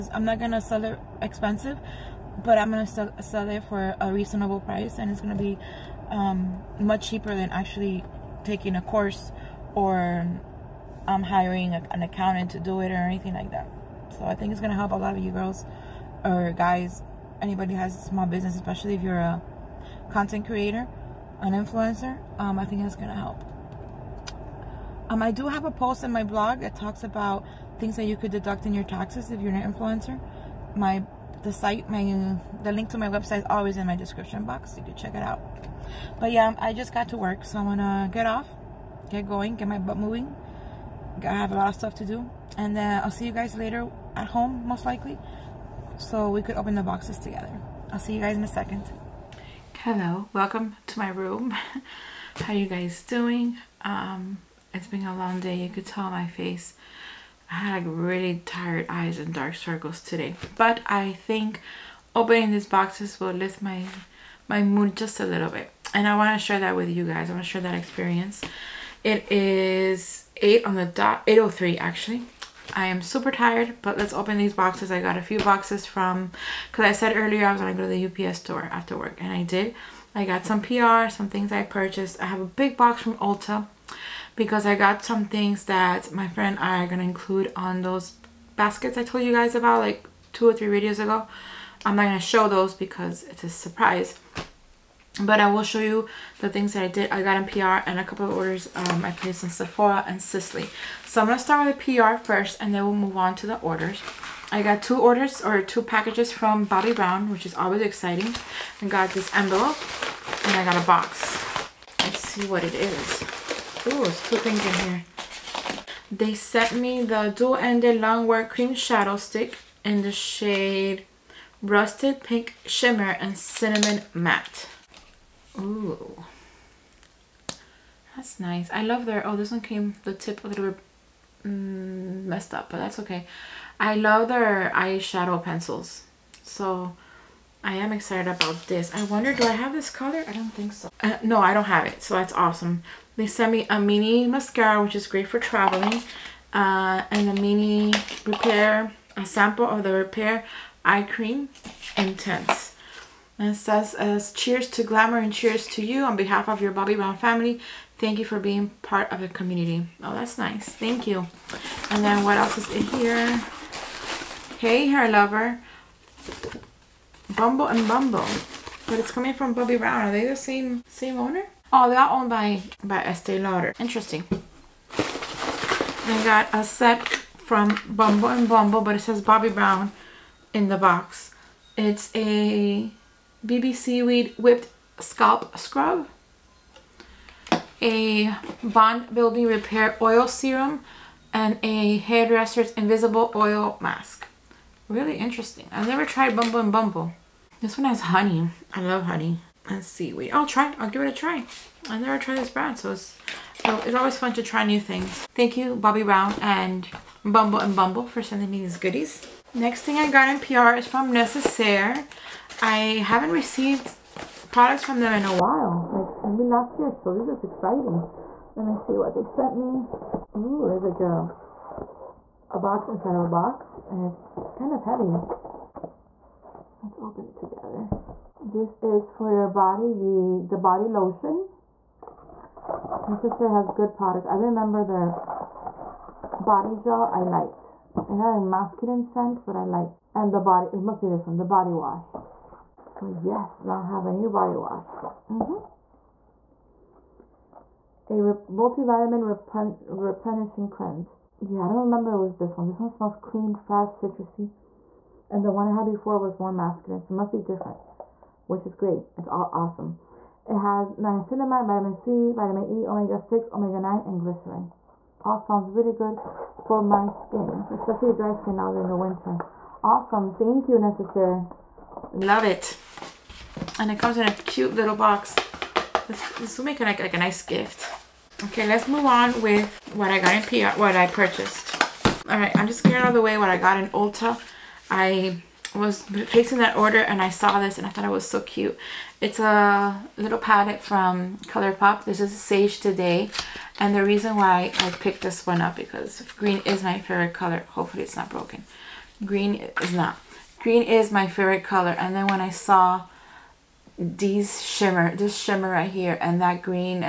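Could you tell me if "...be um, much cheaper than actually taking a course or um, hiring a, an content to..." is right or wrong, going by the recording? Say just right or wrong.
wrong.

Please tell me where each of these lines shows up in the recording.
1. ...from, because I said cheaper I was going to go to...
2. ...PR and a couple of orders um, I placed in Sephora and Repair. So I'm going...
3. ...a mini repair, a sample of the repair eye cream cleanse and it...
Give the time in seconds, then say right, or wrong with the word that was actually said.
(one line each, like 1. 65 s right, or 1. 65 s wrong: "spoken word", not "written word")
1. 75 s wrong: "earlier", not "cheaper"
2. 97 s wrong: "Sisley", not "Repair"
3. 147 s wrong: "intense", not "cleanse".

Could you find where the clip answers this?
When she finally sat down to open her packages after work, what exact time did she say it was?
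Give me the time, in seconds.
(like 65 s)
71 s.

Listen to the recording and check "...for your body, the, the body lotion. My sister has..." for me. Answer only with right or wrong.
right.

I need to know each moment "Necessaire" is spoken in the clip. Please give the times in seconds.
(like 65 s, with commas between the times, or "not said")
211 s, 270 s.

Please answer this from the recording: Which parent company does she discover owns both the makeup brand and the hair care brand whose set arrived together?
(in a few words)
Estee Lauder.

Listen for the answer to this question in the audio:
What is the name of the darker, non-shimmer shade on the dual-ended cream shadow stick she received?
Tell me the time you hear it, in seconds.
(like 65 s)
123 s.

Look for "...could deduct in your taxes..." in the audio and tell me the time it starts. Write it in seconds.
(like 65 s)
28 s.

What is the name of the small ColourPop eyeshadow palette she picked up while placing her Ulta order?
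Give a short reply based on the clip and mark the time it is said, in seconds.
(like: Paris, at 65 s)
Sage the Day, at 292 s.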